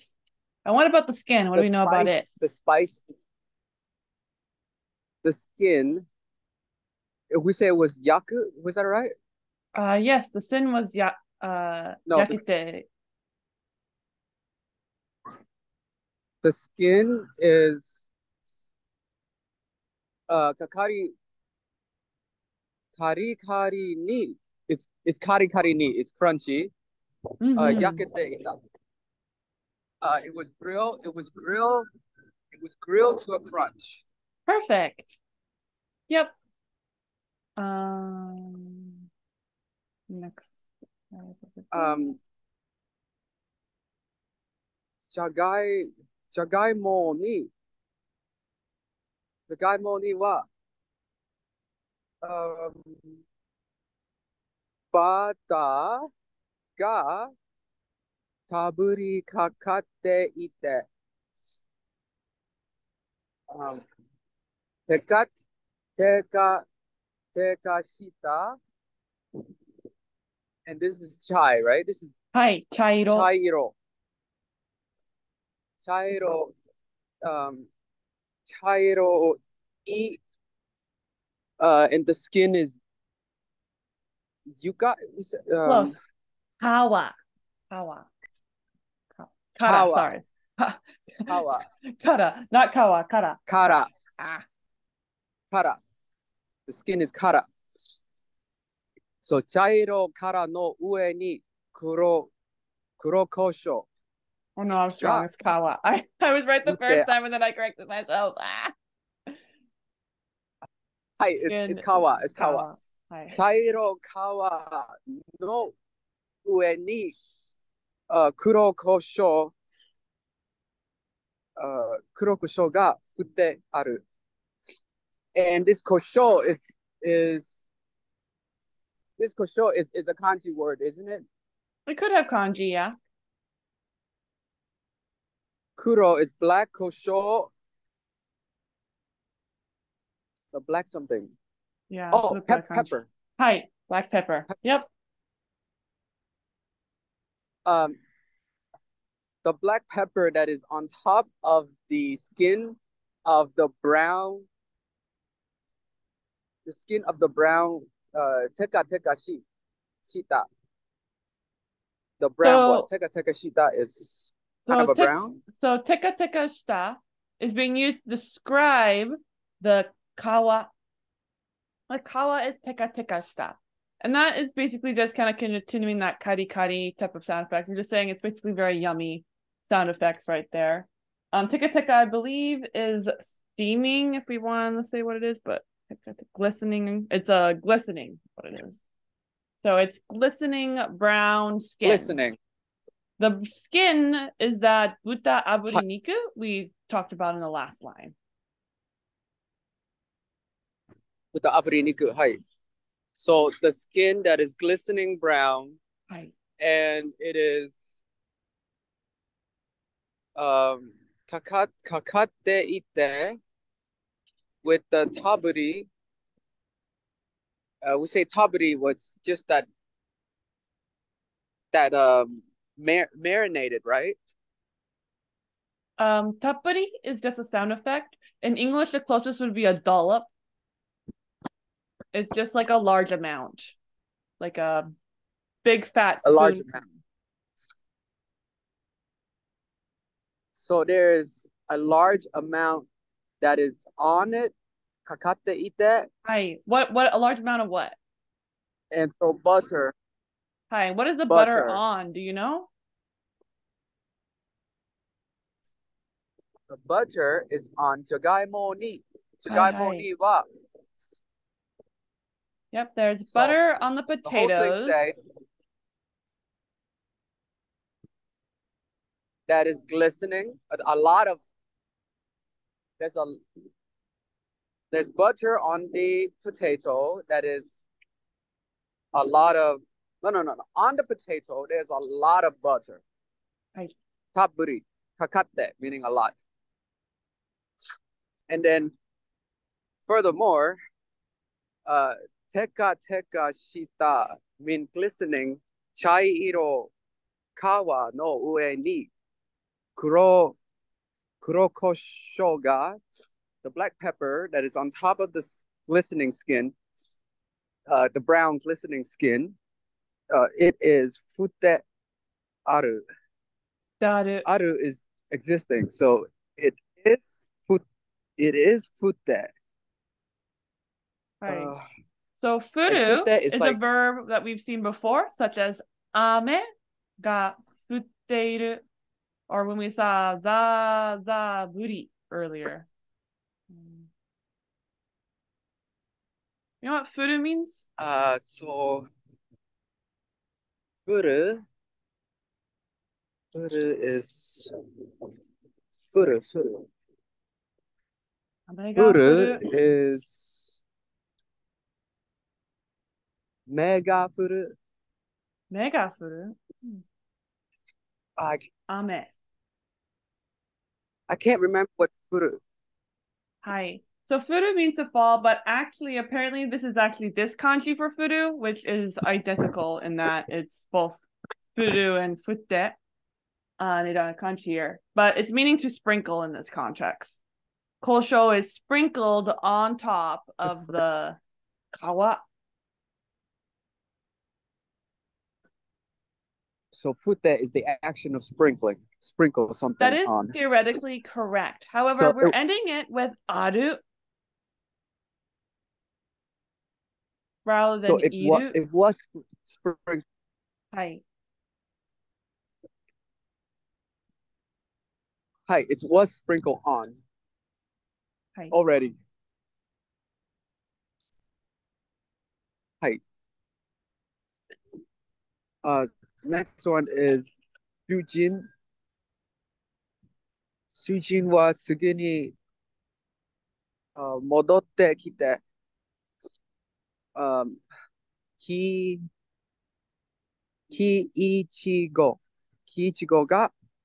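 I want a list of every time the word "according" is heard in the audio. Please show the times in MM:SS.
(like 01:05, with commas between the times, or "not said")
not said.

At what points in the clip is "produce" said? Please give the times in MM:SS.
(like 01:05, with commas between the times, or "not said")
not said.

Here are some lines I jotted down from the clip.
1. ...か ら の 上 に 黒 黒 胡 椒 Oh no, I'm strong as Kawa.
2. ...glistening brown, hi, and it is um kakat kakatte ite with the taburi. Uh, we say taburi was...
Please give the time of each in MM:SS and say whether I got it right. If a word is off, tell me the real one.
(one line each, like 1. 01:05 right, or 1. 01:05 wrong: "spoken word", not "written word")
1. 01:40 right
2. 03:24 right.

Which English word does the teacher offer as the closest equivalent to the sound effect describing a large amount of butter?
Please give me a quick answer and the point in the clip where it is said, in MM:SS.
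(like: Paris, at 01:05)
a dollop, at 03:49.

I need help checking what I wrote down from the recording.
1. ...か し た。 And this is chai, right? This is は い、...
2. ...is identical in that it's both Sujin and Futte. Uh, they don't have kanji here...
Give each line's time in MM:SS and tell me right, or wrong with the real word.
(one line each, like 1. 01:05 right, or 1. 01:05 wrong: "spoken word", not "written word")
1. 01:07 right
2. 06:08 wrong: "Furu", not "Sujin".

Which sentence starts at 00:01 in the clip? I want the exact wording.
What the do we know spice, about it?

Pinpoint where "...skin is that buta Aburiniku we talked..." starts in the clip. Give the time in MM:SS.
03:13.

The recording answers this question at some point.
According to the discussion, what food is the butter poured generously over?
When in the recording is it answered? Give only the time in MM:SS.
04:24.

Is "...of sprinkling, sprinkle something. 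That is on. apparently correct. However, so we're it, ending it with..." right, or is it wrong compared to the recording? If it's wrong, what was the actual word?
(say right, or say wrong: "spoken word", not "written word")
wrong: "theoretically", not "apparently".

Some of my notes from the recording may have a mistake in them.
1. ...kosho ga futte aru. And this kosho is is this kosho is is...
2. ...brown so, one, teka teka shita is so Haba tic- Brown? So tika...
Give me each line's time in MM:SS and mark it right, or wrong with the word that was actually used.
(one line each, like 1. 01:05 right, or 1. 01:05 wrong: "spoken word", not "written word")
1. 02:02 right
2. 02:42 right.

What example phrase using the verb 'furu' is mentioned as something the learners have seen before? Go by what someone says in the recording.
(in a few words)
ame ga futteiru.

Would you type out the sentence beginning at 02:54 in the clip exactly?
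And that is basically just kind of continuing that kari kari type of sound effect.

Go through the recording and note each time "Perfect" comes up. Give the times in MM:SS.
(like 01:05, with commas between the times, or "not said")
00:34.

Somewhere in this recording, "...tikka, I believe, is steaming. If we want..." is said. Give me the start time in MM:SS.
03:01.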